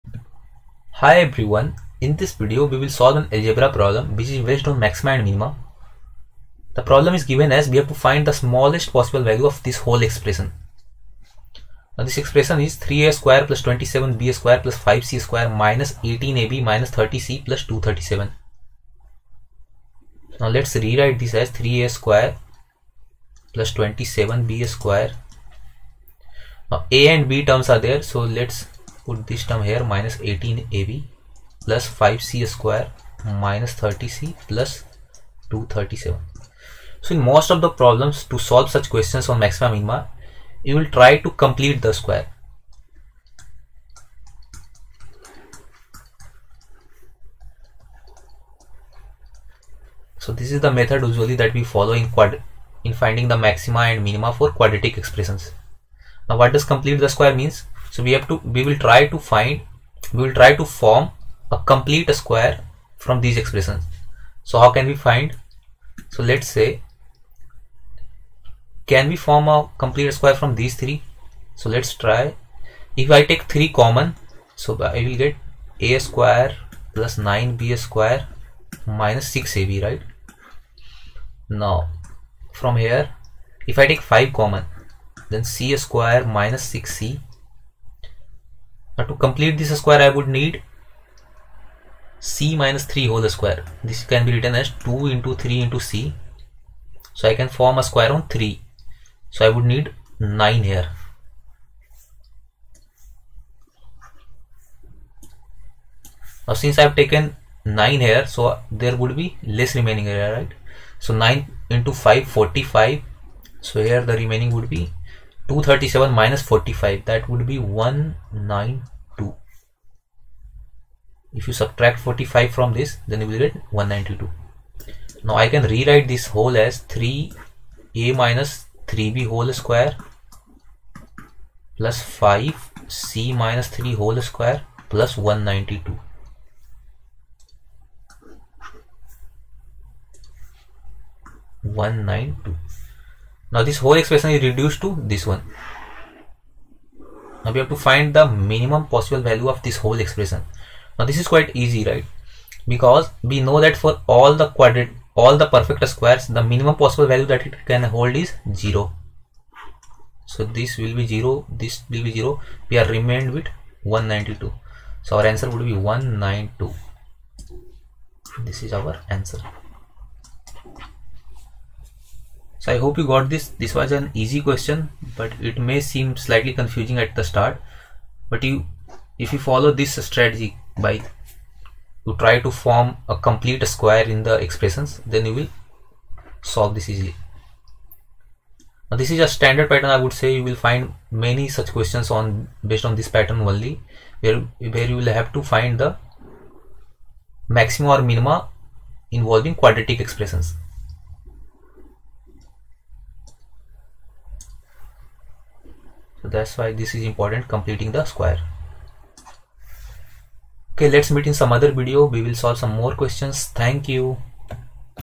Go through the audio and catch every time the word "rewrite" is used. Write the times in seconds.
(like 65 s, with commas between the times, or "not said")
20 s, 125 s.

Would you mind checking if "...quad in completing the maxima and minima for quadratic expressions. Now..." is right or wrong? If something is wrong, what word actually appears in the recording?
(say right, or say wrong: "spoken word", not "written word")
wrong: "finding", not "completing".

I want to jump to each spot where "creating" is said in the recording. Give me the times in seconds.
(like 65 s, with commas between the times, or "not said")
not said.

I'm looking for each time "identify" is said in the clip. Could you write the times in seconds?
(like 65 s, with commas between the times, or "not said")
not said.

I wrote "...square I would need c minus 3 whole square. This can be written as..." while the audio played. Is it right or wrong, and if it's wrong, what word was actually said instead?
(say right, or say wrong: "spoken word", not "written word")
right.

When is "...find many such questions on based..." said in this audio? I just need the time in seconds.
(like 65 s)
190 s.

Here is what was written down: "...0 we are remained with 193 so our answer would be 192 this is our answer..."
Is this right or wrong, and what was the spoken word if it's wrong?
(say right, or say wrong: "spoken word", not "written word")
wrong: "192", not "193".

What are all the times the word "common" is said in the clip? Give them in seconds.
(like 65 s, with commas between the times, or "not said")
73 s, 84 s.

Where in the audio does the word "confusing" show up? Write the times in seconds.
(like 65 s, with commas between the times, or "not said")
176 s.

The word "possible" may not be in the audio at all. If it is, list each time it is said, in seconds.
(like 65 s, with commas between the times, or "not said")
8 s, 148 s, 156 s.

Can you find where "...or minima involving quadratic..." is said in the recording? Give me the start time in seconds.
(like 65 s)
197 s.